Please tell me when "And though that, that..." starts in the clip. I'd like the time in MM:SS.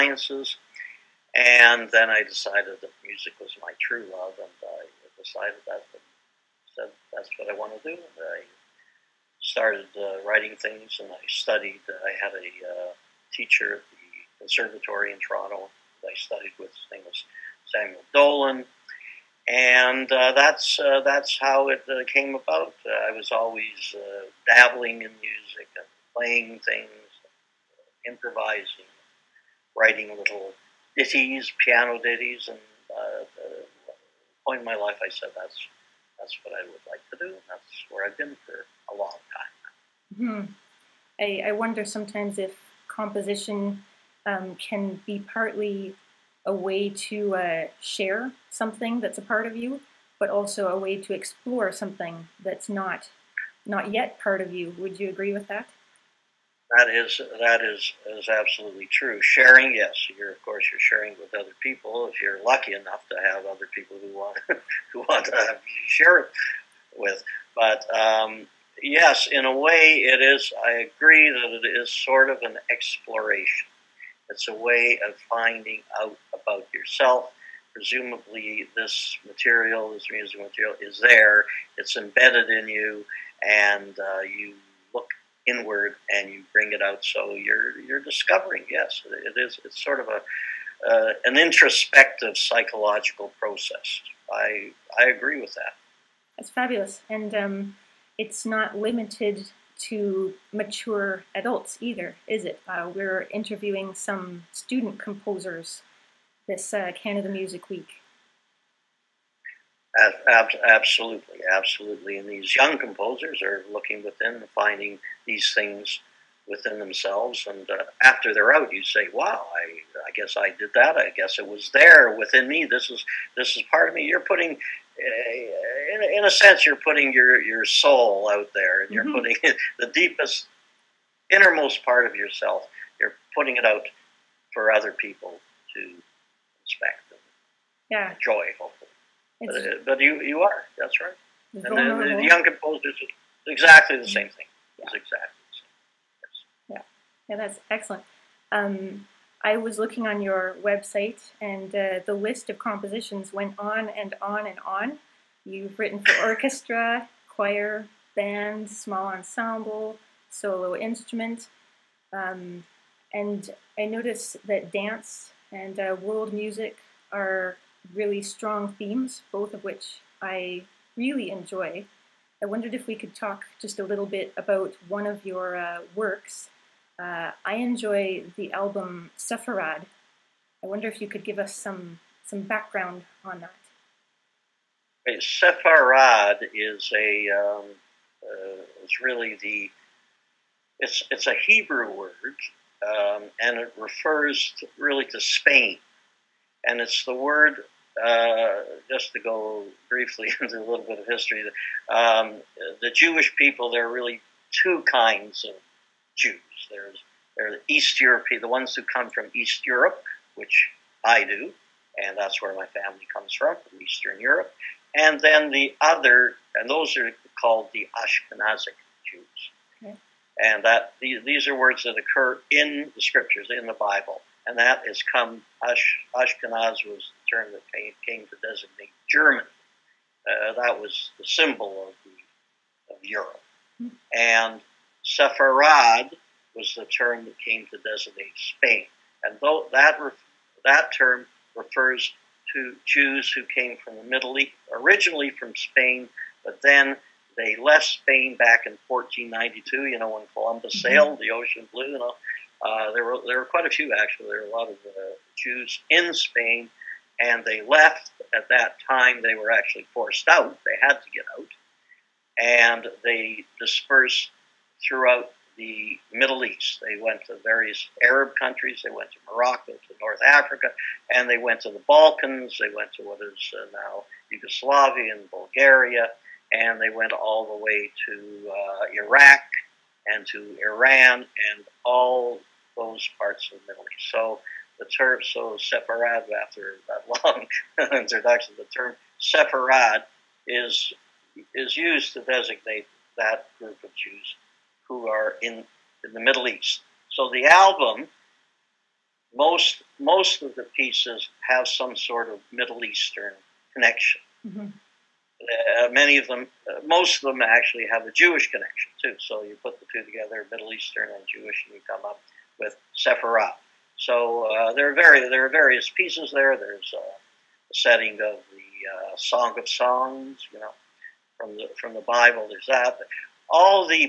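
03:59.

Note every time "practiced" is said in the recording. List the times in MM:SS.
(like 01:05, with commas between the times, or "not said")
not said.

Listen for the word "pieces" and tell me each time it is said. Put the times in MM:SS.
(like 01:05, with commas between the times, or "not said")
05:00, 05:15.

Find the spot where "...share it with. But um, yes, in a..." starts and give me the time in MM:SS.
01:05.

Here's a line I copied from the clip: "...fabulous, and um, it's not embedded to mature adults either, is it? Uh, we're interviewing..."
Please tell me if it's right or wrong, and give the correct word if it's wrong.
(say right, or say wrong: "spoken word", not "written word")
wrong: "limited", not "embedded".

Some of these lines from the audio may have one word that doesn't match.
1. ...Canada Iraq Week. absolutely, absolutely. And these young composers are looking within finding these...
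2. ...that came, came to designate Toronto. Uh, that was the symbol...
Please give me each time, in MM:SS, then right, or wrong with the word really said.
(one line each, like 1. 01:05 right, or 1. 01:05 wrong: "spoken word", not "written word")
1. 01:46 wrong: "Music", not "Iraq"
2. 03:47 wrong: "German", not "Toronto".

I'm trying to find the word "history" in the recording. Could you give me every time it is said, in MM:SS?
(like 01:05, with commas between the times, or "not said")
03:21.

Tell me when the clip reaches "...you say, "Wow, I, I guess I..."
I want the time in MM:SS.
01:58.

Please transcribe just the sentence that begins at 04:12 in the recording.
Uh, there, were, there were quite a few, actually.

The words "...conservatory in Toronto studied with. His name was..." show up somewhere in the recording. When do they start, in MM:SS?
00:14.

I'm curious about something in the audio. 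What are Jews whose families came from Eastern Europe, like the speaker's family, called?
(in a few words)
Ashkenazic Jews.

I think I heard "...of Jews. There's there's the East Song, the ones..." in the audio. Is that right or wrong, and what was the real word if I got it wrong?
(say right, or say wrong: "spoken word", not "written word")
wrong: "European", not "Song".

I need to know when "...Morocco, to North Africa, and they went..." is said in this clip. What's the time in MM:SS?
04:29.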